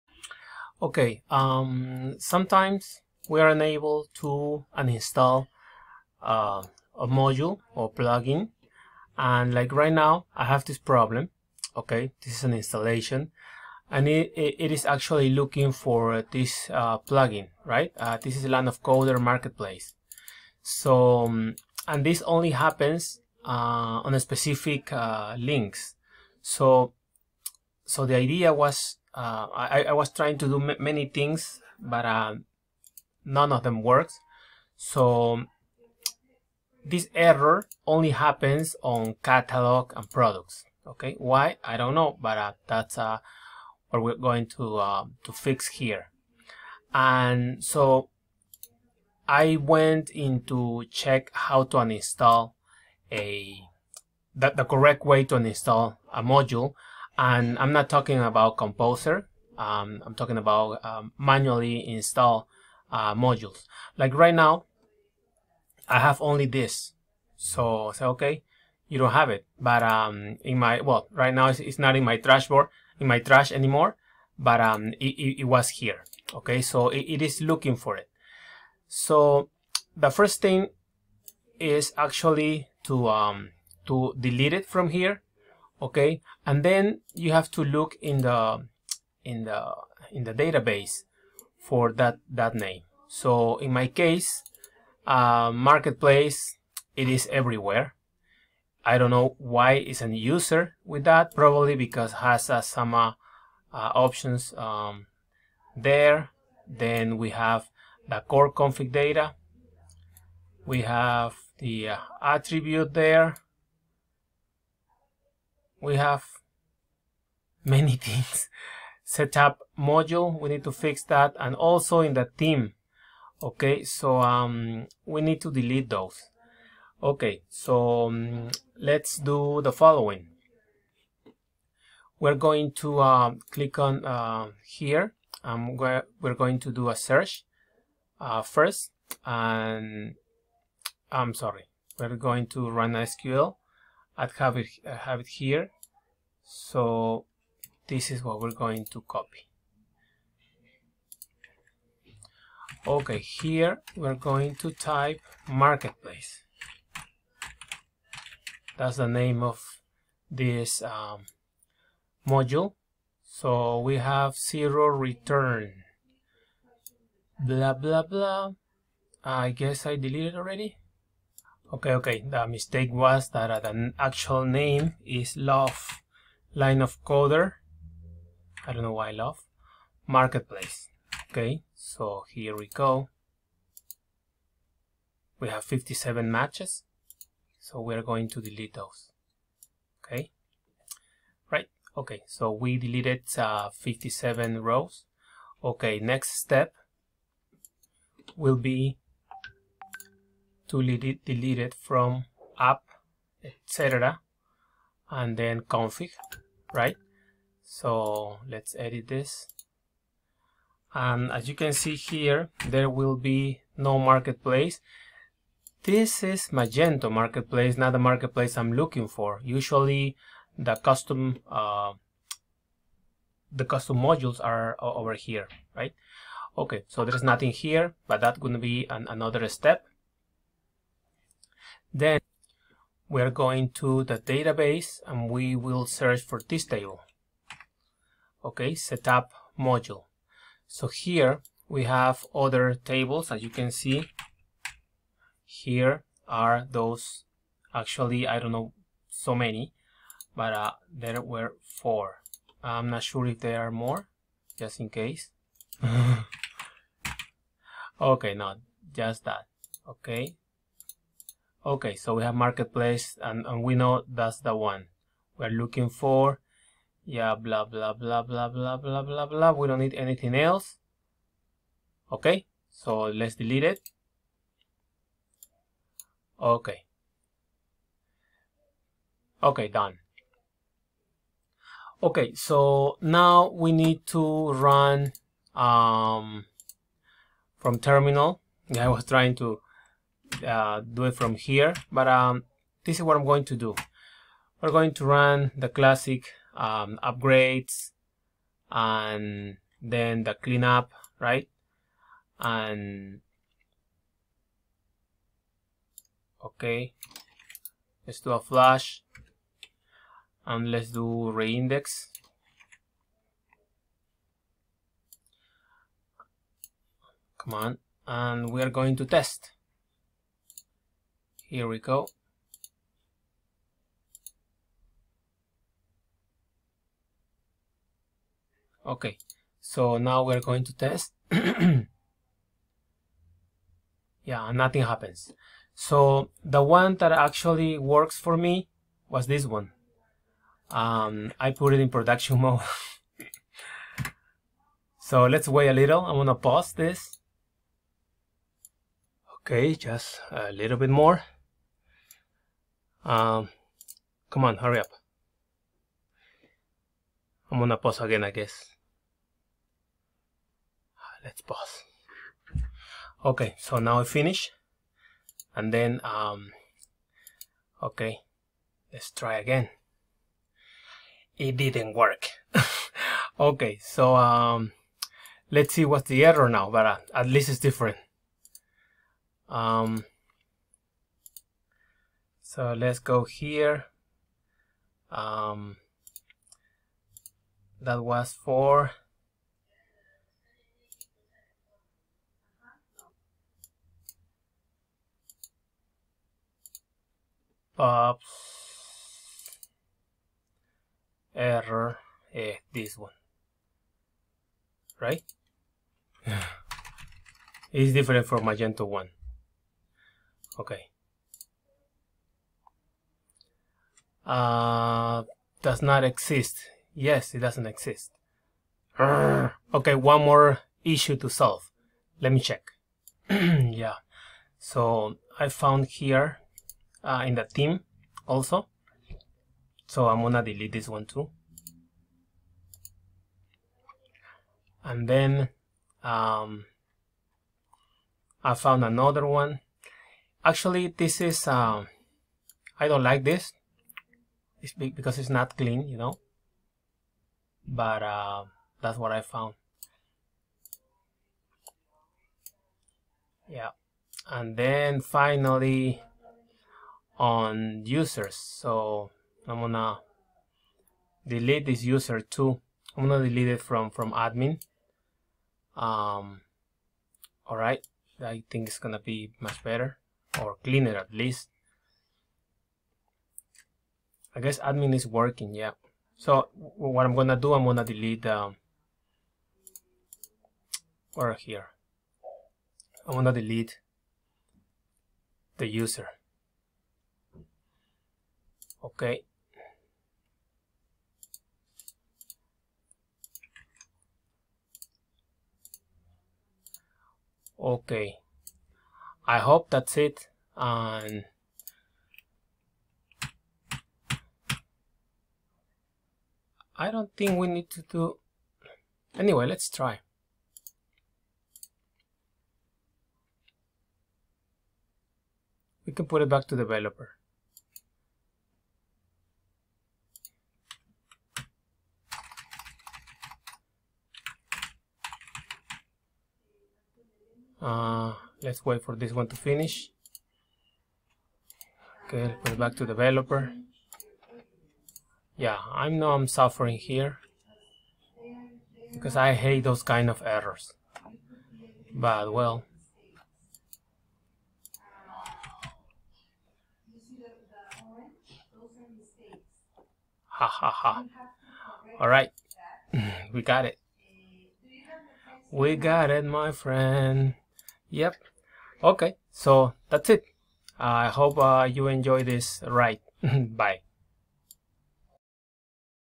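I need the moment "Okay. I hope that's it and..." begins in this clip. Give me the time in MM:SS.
08:17.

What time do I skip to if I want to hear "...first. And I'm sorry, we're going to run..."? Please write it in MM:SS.
02:18.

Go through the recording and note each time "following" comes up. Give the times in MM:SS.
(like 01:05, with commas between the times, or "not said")
02:09.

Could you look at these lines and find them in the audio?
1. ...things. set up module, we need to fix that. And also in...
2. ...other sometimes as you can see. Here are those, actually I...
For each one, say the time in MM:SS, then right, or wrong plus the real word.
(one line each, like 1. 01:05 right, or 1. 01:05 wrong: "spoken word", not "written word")
1. 01:57 right
2. 04:02 wrong: "tables", not "sometimes".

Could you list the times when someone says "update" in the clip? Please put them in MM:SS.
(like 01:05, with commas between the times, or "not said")
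not said.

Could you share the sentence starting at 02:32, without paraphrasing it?
Okay, here we're going to type marketplace.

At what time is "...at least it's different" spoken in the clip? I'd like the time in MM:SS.
06:17.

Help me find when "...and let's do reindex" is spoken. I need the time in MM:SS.
05:10.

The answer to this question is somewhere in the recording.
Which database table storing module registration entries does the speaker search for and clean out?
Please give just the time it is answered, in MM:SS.
03:58.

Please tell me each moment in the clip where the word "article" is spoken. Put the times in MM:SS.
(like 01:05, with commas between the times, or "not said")
not said.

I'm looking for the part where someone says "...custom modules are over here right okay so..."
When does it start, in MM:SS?
03:43.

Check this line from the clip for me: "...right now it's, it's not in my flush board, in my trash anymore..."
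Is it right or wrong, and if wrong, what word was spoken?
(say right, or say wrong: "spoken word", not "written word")
wrong: "trash", not "flush".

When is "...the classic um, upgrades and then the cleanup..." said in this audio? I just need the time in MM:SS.
04:55.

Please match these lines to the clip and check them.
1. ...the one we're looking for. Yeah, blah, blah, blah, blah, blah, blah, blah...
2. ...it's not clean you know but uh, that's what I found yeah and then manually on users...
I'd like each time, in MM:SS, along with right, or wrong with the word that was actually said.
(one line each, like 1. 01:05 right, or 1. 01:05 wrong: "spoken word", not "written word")
1. 04:24 right
2. 07:25 wrong: "finally", not "manually".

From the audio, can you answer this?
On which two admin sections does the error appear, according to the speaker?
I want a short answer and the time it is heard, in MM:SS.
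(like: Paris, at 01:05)
catalog and products, at 00:39.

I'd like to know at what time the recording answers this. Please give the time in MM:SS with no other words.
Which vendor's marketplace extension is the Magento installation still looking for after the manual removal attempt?
00:18.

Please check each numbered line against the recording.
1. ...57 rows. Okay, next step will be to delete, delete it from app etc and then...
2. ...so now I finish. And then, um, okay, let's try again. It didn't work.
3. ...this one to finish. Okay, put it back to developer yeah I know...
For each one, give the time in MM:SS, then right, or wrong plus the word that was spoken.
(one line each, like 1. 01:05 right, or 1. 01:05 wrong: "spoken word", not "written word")
1. 03:13 right
2. 06:03 right
3. 08:48 right.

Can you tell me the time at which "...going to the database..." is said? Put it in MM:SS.
03:53.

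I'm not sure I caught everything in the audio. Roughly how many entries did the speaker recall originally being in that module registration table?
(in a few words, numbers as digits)
4.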